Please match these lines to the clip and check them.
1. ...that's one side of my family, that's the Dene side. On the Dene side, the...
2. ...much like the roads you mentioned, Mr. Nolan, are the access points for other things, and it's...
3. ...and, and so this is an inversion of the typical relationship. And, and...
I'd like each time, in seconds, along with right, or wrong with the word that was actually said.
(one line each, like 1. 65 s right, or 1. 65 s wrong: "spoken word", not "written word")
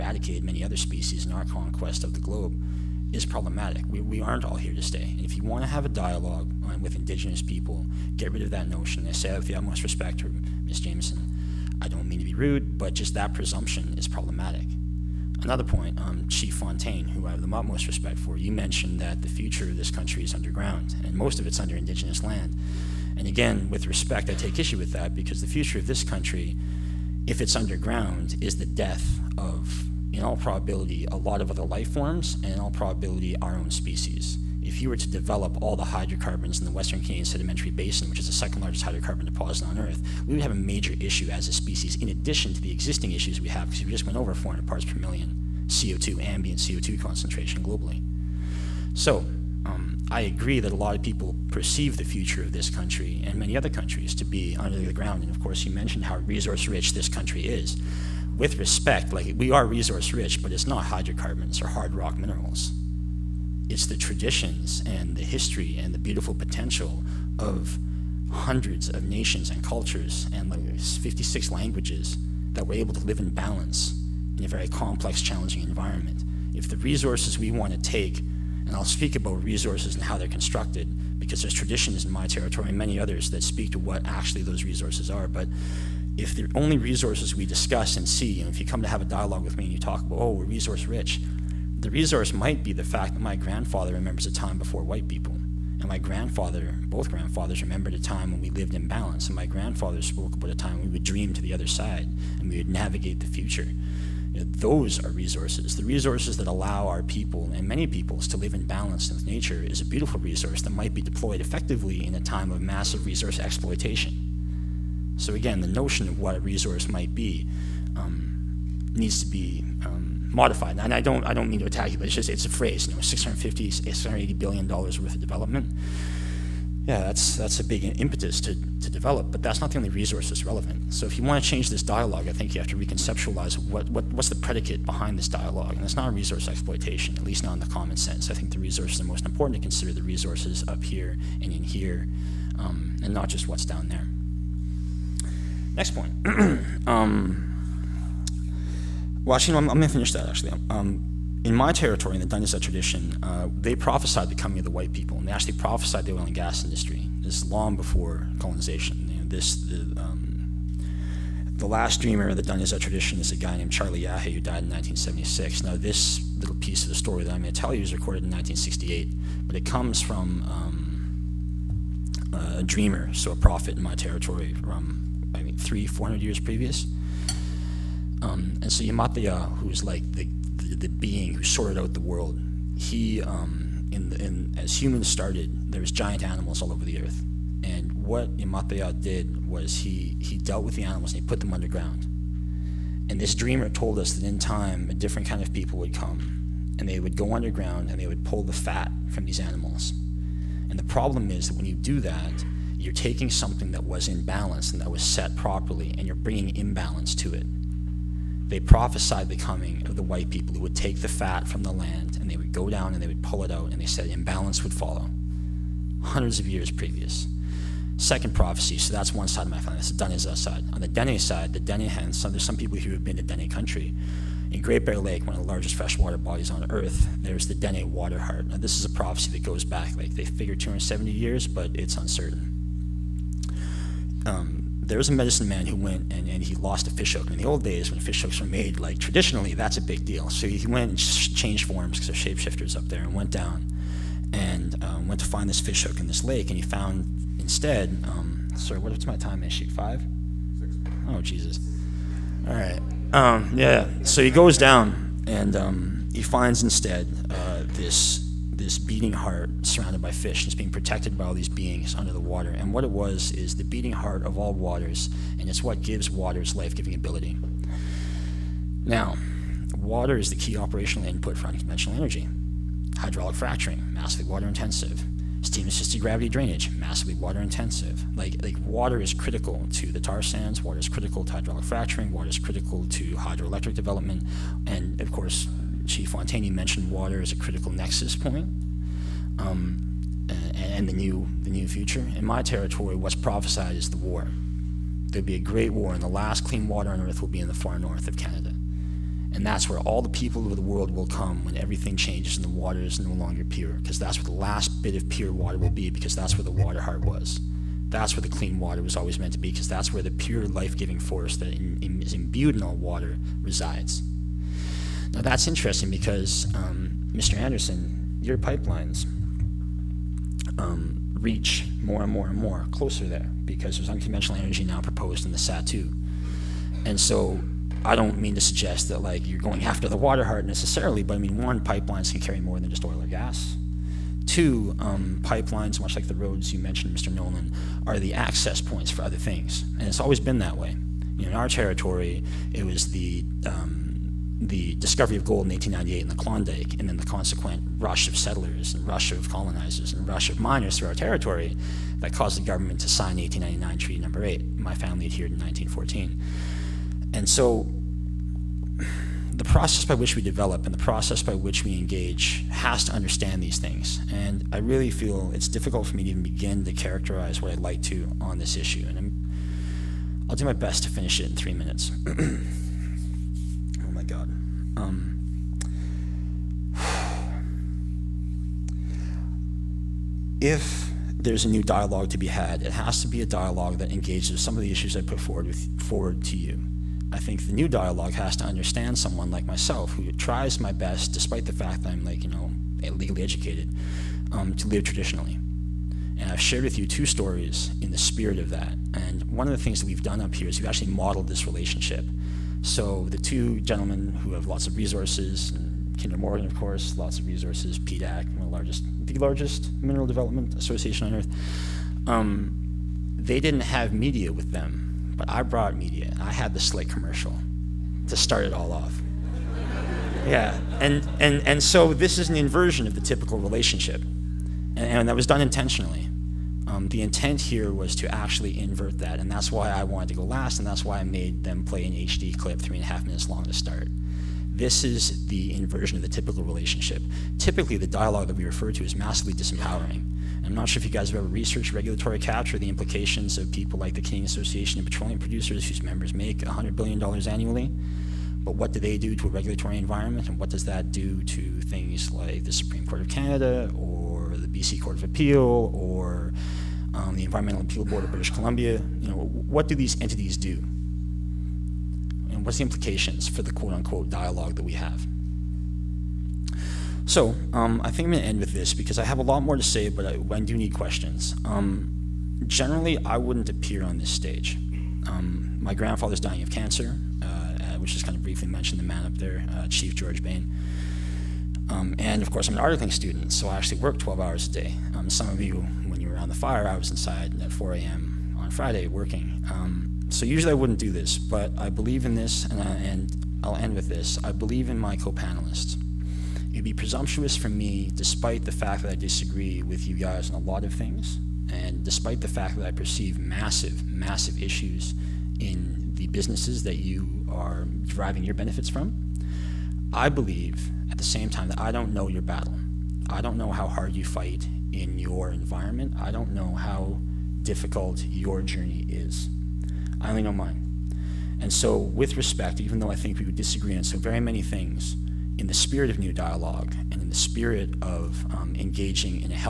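1. 218 s right
2. 335 s right
3. 421 s right.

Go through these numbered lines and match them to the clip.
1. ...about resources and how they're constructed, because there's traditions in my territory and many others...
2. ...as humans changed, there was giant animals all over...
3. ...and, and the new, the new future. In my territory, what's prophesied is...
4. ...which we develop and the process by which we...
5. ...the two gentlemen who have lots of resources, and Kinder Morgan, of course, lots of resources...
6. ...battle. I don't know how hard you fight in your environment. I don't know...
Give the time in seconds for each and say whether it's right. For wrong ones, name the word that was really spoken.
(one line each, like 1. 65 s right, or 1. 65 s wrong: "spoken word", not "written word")
1. 79 s right
2. 184 s wrong: "started", not "changed"
3. 290 s right
4. 359 s right
5. 403 s right
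6. 512 s right.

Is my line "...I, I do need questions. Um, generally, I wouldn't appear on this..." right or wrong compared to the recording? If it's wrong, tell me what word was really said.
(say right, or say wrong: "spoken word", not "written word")
right.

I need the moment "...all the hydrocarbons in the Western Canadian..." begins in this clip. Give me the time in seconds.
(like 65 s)
35 s.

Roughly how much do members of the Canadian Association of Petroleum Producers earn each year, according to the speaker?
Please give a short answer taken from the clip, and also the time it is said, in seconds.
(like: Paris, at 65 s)
$100 billion, at 446 s.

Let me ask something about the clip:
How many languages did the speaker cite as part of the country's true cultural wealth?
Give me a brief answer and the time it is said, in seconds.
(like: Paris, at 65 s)
56, at 70 s.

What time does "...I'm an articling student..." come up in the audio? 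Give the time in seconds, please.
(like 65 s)
482 s.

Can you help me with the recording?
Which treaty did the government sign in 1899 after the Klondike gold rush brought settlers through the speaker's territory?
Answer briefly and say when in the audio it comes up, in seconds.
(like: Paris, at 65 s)
Treaty Number 8, at 353 s.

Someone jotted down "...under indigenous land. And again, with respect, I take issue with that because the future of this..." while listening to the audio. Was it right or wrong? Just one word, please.
right.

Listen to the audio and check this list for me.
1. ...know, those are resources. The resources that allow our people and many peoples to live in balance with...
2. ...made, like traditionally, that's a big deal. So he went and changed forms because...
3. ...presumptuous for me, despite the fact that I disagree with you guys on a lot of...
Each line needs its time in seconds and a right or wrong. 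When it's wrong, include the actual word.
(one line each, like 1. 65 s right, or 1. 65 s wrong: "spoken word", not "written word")
1. 104 s right
2. 238 s right
3. 496 s right.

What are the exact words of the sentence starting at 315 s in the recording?
Now, that's interesting because, um, Mr.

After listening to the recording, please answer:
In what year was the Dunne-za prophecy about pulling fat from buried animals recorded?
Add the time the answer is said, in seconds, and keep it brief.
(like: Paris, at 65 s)
1968, at 168 s.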